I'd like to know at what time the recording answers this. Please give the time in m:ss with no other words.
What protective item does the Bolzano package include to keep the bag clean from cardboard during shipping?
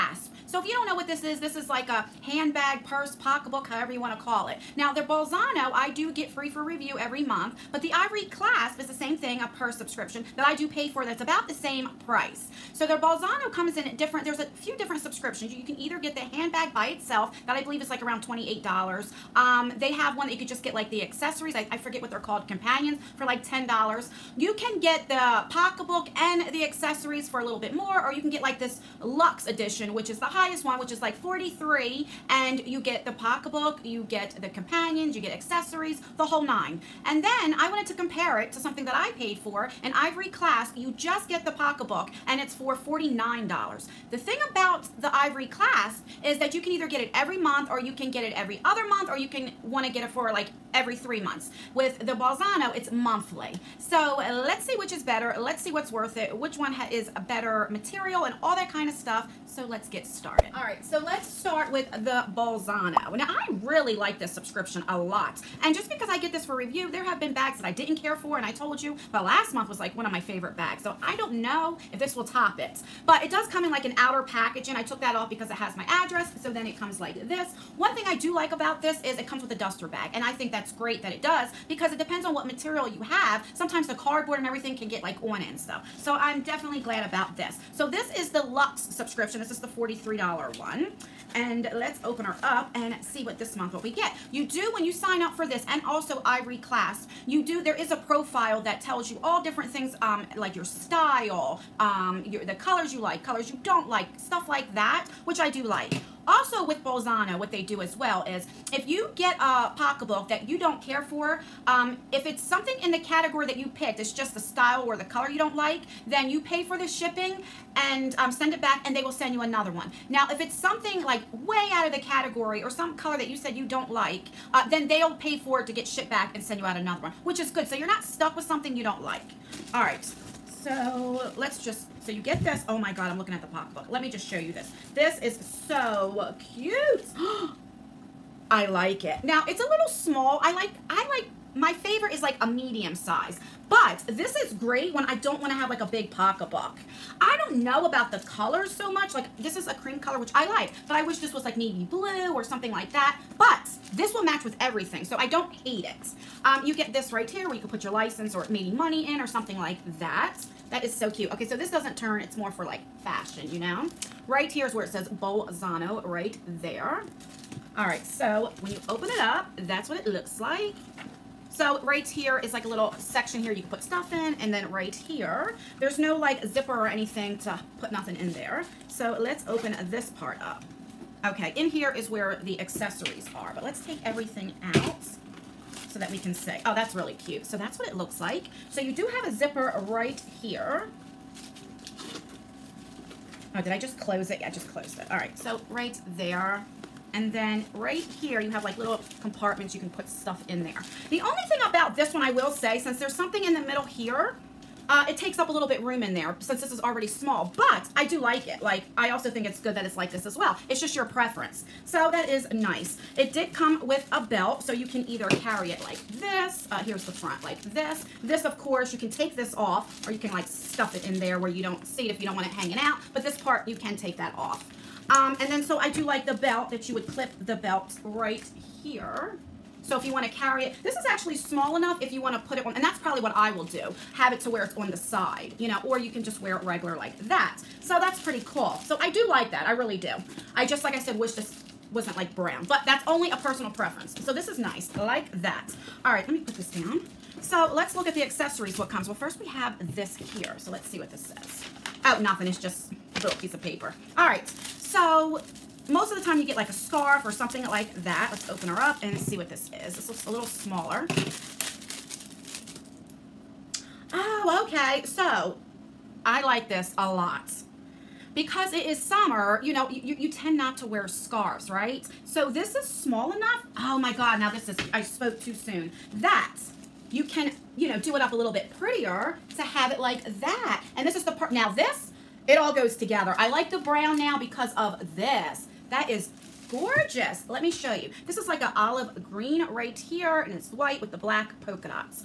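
1:19.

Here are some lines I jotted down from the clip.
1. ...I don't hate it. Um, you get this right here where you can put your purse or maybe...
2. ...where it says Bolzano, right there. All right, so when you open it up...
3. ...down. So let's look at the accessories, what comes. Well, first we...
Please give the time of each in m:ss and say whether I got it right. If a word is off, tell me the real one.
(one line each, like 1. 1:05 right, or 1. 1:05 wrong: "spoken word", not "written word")
1. 2:35 wrong: "license", not "purse"
2. 2:44 right
3. 4:06 right.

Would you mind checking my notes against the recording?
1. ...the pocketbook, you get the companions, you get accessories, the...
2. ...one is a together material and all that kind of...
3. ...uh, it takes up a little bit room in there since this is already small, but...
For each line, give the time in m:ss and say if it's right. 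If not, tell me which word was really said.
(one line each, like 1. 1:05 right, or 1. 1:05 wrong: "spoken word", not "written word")
1. 0:33 right
2. 0:56 wrong: "better", not "together"
3. 3:24 right.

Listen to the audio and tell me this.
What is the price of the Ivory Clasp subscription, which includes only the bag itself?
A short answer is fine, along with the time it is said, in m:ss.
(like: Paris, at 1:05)
$49, at 0:42.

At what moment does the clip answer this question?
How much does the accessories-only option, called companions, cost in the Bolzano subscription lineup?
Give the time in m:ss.
0:23.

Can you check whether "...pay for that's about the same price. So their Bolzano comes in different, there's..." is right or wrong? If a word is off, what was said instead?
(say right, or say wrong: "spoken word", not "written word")
right.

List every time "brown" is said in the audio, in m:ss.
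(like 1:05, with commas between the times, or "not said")
4:02, 4:43.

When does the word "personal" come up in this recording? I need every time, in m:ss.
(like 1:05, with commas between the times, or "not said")
4:03.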